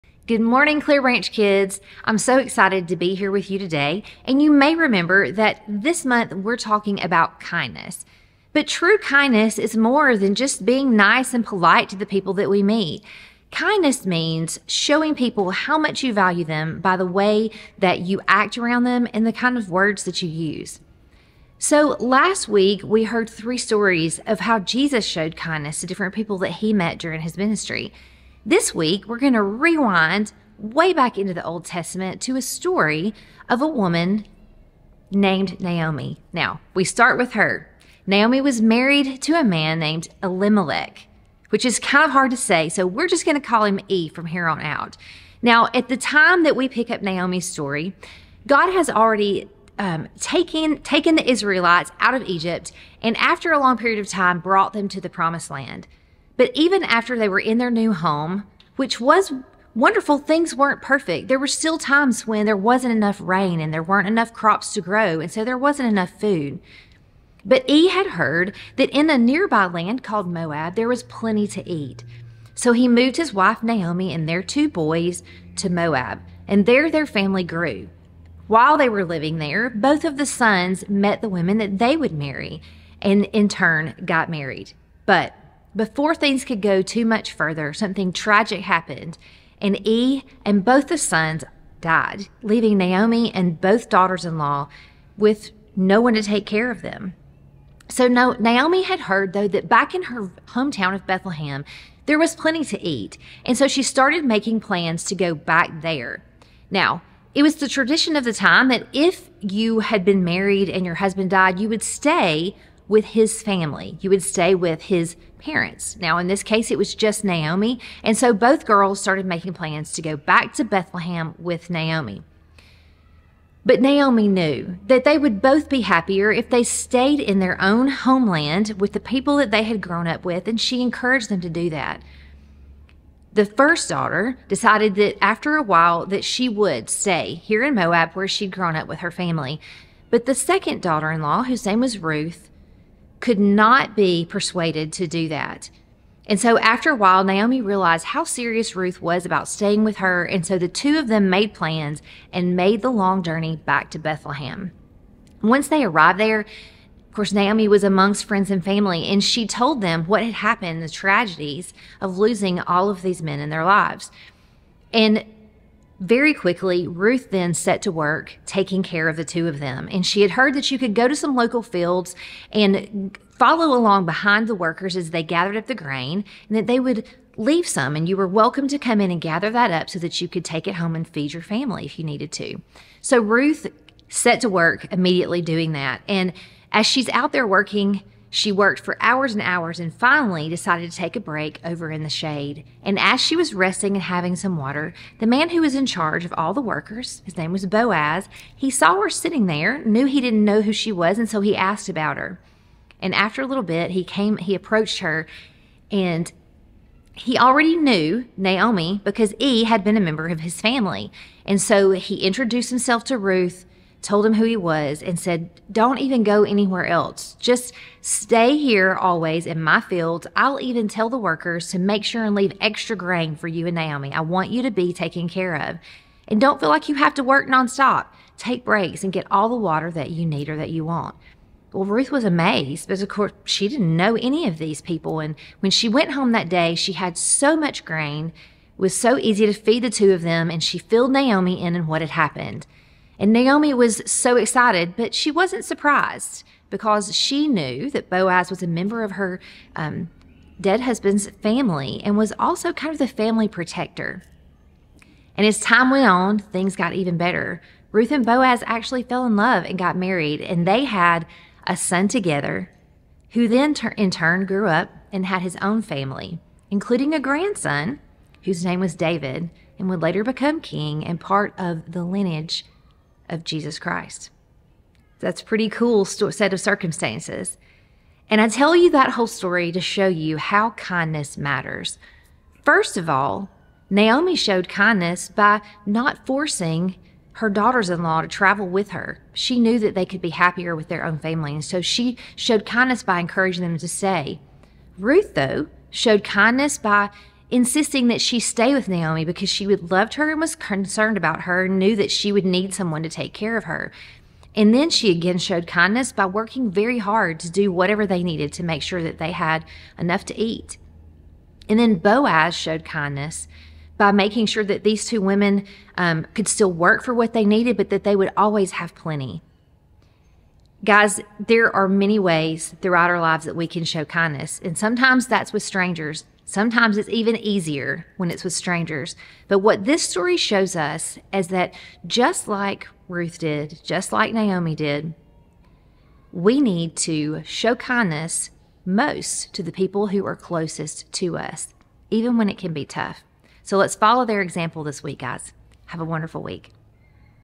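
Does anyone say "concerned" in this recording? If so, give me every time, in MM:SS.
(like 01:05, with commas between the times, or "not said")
05:00.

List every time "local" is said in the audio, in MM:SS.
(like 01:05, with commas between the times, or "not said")
02:51.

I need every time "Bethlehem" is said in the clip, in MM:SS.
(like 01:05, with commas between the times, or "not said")
01:41, 02:00, 02:33.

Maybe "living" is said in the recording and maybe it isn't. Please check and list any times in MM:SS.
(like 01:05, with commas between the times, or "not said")
01:19.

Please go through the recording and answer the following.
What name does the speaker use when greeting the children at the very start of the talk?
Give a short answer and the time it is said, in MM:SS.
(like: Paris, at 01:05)
Clearbranch, at 00:00.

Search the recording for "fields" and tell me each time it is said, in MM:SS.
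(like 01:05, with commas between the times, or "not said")
02:51, 03:39.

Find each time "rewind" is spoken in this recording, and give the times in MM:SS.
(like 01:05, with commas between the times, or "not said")
00:29.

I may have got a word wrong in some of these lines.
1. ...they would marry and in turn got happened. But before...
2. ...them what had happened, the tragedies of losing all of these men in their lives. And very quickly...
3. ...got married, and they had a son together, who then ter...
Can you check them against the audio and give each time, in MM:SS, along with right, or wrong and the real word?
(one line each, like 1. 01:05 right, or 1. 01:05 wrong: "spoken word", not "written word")
1. 01:21 wrong: "married", not "happened"
2. 02:39 right
3. 04:19 right.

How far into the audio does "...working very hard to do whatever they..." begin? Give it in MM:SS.
05:06.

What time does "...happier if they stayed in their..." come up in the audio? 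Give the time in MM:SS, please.
02:05.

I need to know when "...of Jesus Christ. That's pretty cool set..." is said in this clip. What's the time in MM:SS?
04:33.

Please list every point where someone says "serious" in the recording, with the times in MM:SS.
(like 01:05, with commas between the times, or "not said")
02:28.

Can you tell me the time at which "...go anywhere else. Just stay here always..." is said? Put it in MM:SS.
03:36.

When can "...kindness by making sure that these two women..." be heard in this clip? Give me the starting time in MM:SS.
05:12.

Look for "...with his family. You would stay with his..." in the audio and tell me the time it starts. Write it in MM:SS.
01:52.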